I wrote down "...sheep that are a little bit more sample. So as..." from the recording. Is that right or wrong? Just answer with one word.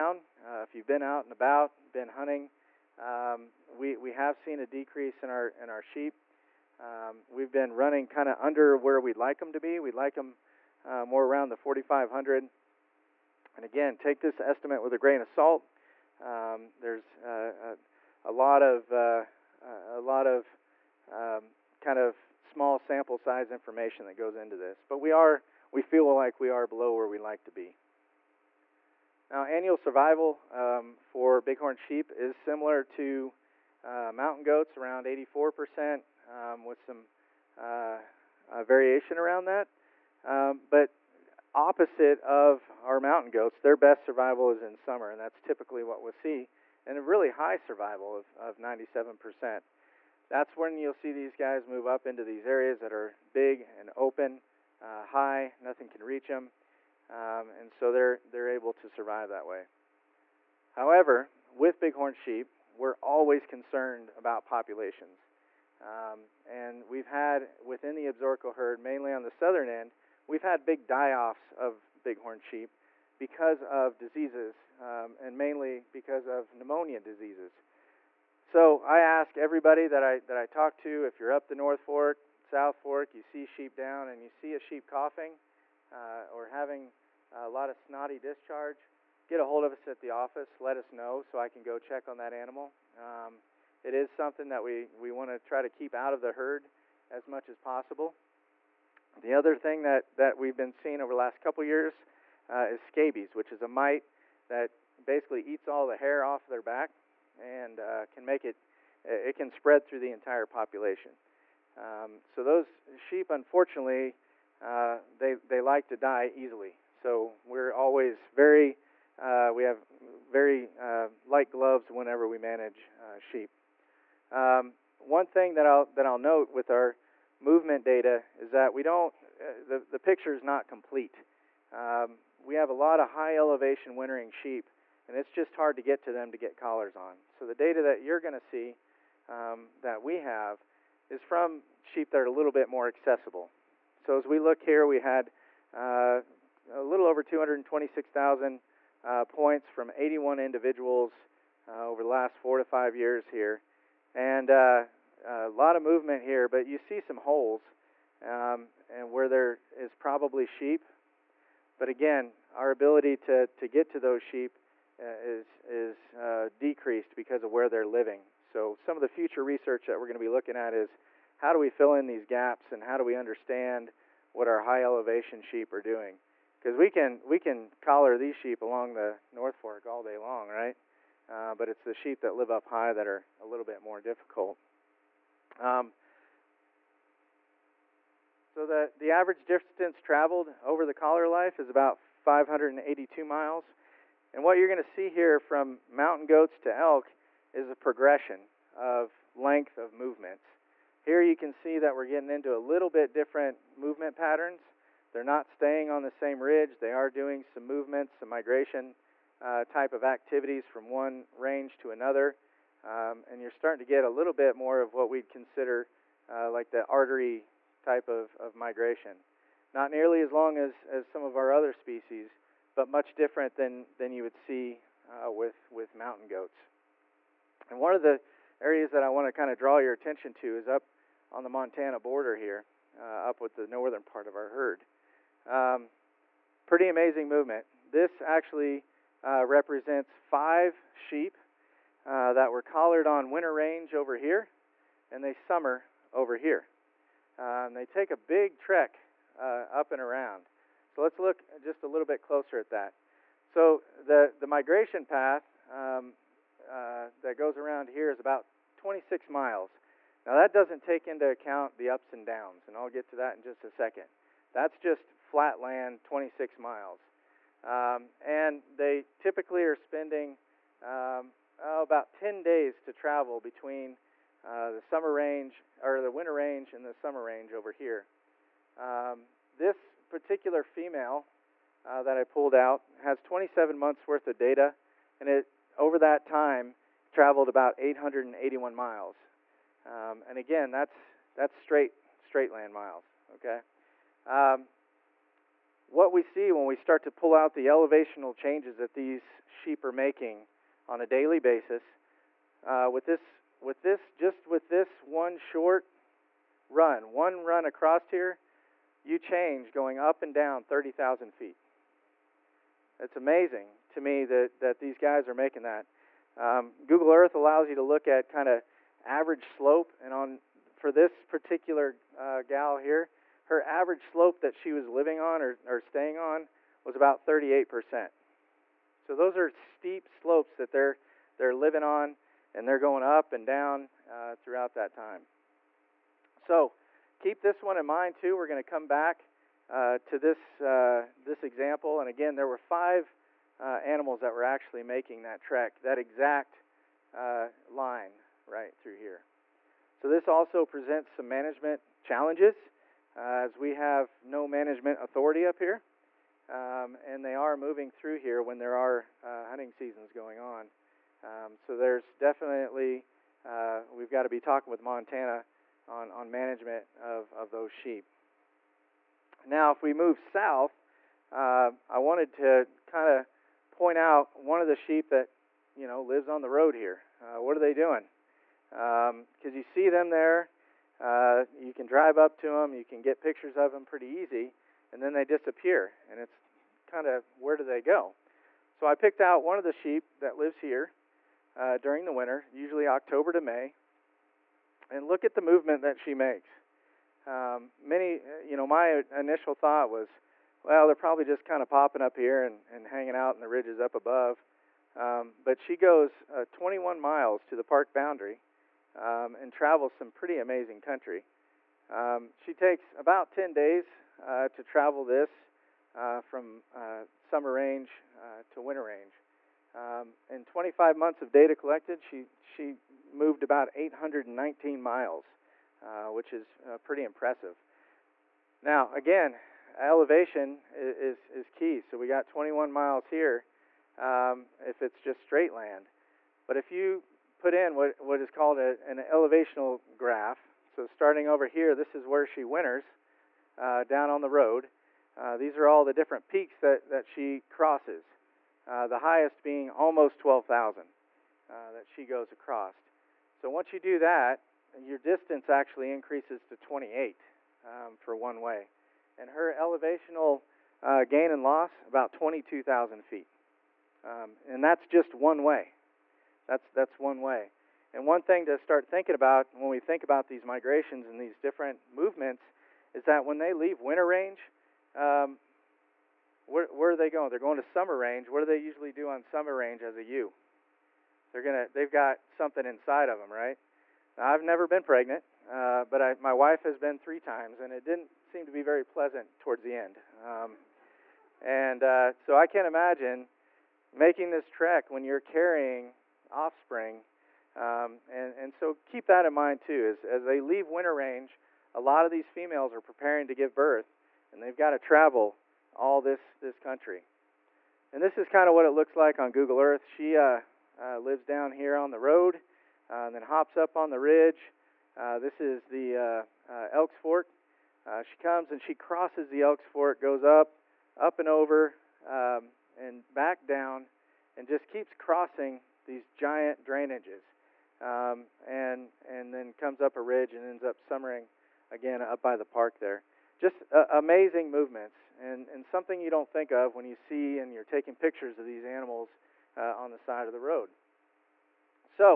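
wrong.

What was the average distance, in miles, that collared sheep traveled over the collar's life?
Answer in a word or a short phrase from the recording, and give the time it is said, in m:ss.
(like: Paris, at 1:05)
582 miles, at 3:12.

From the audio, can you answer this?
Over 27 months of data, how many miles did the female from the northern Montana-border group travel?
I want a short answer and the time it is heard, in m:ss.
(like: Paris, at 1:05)
881 miles, at 4:47.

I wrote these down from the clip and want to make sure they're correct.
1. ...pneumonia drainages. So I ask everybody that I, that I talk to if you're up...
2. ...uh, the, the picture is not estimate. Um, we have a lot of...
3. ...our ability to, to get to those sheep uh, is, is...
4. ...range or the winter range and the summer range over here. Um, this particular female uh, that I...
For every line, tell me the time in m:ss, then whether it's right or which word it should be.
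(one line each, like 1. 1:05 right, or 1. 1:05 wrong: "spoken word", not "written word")
1. 1:16 wrong: "diseases", not "drainages"
2. 2:09 wrong: "complete", not "estimate"
3. 2:42 right
4. 4:35 right.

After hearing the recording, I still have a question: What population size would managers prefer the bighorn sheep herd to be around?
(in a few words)
4,500.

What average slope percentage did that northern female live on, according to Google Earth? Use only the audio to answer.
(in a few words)
38%.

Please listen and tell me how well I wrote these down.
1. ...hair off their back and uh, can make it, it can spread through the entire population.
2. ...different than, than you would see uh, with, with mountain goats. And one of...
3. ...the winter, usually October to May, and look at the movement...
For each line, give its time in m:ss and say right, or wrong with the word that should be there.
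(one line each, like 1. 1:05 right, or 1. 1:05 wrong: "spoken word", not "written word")
1. 1:45 right
2. 3:43 right
3. 6:32 right.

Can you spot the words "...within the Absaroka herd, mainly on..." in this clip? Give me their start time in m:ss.
1:07.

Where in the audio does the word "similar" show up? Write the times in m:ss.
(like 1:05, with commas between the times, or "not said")
0:32.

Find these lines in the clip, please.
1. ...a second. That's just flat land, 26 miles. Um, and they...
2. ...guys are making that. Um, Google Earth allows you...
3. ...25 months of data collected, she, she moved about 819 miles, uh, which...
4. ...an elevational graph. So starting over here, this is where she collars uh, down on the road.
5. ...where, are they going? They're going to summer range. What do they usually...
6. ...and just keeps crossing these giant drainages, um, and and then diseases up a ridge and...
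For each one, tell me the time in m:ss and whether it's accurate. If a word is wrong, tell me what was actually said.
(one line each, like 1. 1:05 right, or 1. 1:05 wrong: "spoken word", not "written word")
1. 4:23 right
2. 5:14 right
3. 7:00 right
4. 7:18 wrong: "winters", not "collars"
5. 7:56 right
6. 8:44 wrong: "comes", not "diseases".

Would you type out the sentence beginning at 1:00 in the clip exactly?
However, with bighorn sheep, we're always concerned about populations.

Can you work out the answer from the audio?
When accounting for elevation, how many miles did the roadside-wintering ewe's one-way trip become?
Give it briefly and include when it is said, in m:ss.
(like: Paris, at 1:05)
28, at 7:36.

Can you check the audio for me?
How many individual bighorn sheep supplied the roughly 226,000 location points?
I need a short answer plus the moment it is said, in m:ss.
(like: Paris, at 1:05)
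81, at 2:29.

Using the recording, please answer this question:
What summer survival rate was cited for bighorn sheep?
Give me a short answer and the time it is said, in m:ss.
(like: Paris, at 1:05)
97%, at 0:48.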